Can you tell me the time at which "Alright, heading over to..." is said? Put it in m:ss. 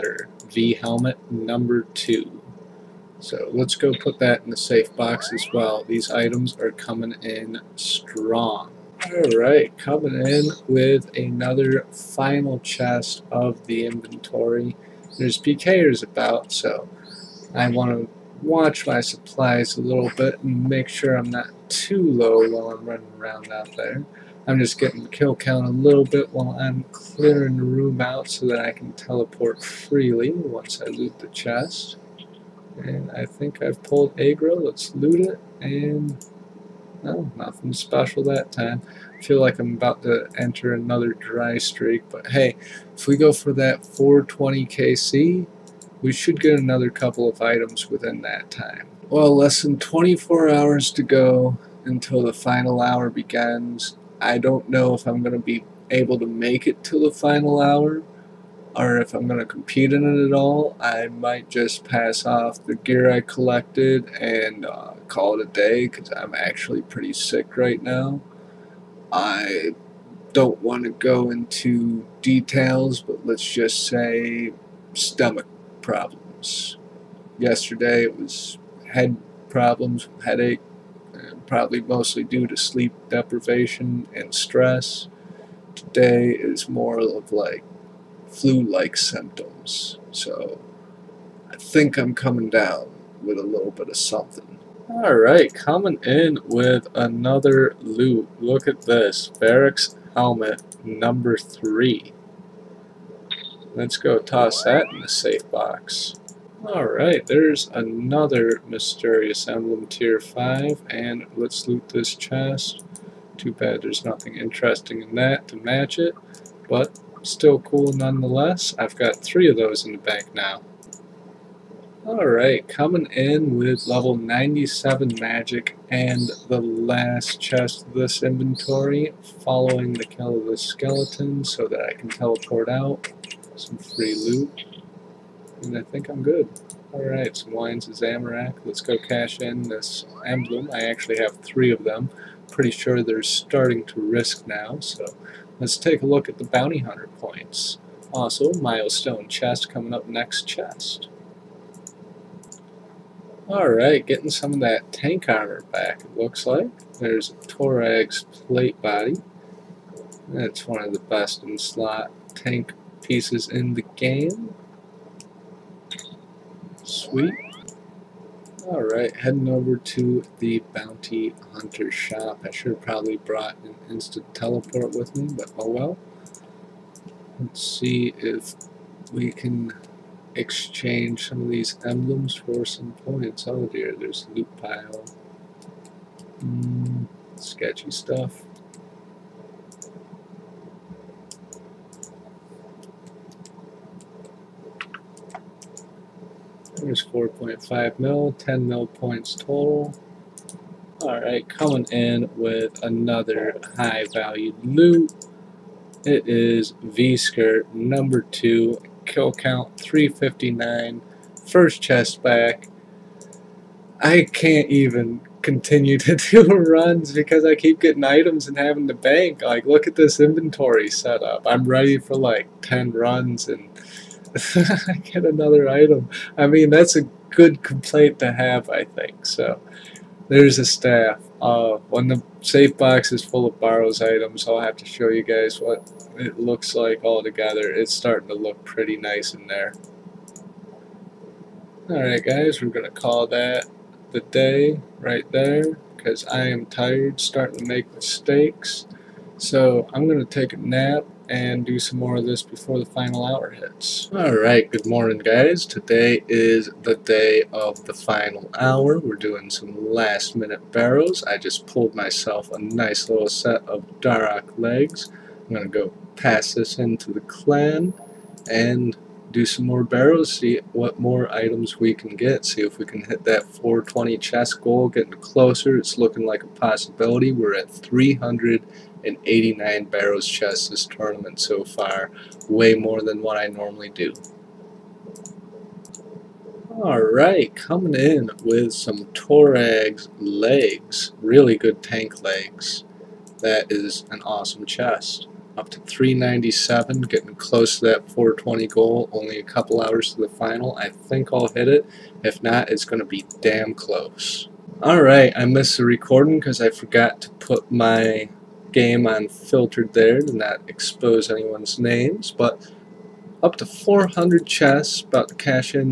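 2:48.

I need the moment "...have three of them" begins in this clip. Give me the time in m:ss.
2:21.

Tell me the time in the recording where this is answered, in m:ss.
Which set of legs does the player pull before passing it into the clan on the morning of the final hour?
4:23.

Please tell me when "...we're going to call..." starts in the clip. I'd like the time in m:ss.
4:02.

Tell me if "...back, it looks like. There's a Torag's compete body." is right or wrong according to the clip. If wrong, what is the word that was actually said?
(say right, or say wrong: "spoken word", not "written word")
wrong: "plate", not "compete".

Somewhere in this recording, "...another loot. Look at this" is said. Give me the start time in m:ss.
1:36.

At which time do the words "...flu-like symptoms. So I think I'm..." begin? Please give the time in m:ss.
1:28.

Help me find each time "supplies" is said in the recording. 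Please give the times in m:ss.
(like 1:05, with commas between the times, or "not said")
0:18.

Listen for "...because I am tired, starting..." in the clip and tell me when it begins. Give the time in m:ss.
4:05.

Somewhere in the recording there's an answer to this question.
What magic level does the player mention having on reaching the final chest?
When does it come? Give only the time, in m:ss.
2:03.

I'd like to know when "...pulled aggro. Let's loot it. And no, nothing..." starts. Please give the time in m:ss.
0:33.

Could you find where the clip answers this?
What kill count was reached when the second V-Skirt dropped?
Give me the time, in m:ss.
3:29.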